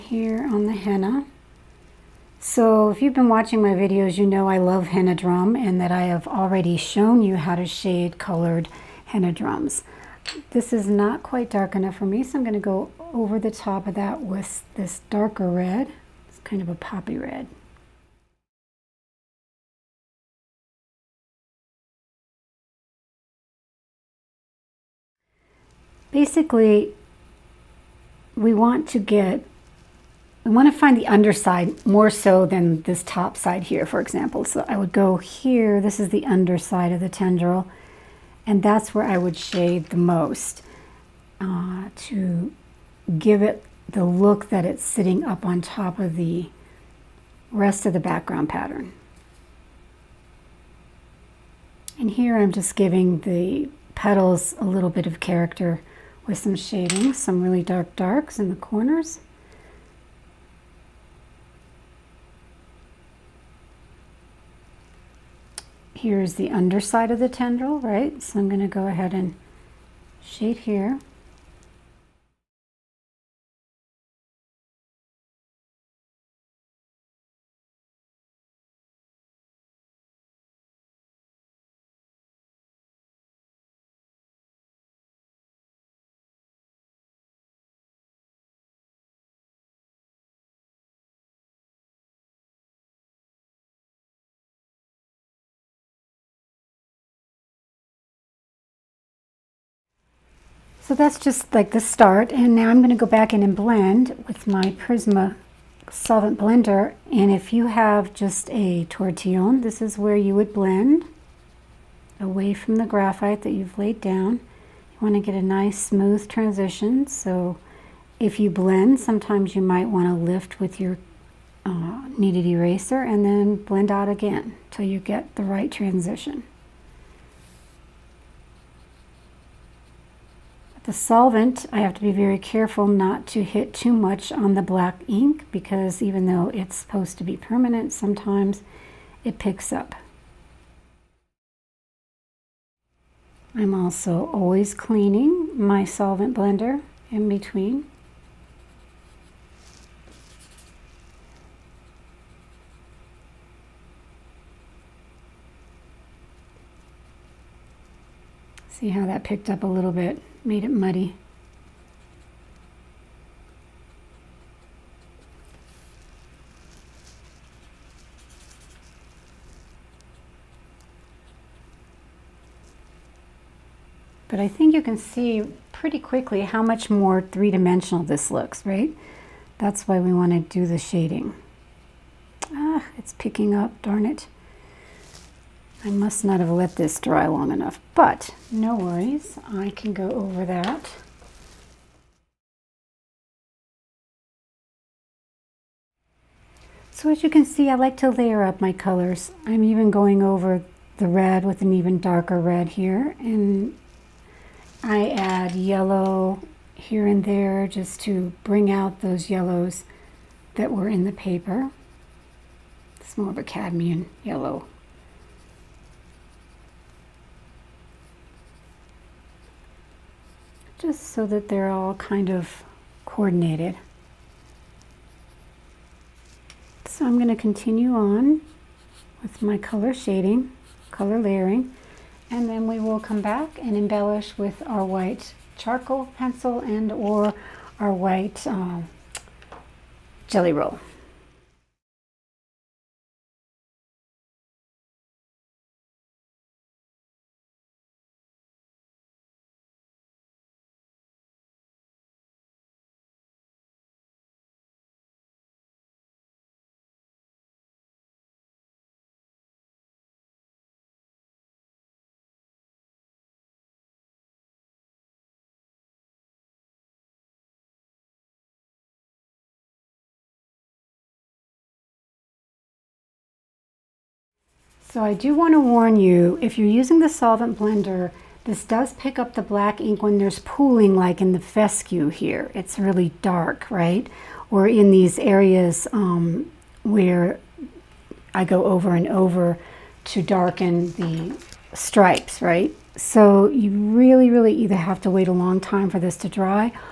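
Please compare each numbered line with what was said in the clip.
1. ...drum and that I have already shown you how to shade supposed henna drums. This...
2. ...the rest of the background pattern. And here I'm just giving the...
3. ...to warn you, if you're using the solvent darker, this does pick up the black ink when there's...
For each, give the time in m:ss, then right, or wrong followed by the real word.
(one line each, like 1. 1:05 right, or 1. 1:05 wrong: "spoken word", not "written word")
1. 0:05 wrong: "colored", not "supposed"
2. 0:46 right
3. 4:35 wrong: "blender", not "darker".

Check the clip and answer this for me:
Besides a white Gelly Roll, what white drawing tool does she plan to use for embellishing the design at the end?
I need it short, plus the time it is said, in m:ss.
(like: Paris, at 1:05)
white charcoal pencil, at 3:54.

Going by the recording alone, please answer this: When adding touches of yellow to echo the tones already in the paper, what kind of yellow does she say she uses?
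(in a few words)
cadmium yellow.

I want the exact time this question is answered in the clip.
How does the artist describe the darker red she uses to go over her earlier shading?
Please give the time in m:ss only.
0:16.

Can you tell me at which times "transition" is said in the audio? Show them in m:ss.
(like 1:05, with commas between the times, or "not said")
1:56, 2:05.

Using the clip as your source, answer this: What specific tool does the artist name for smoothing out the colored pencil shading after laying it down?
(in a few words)
Prisma solvent blender.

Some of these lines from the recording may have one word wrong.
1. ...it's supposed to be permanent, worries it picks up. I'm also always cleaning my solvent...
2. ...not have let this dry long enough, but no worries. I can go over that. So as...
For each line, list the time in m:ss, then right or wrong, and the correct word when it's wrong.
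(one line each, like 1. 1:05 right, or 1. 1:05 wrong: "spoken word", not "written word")
1. 2:16 wrong: "sometimes", not "worries"
2. 3:06 right.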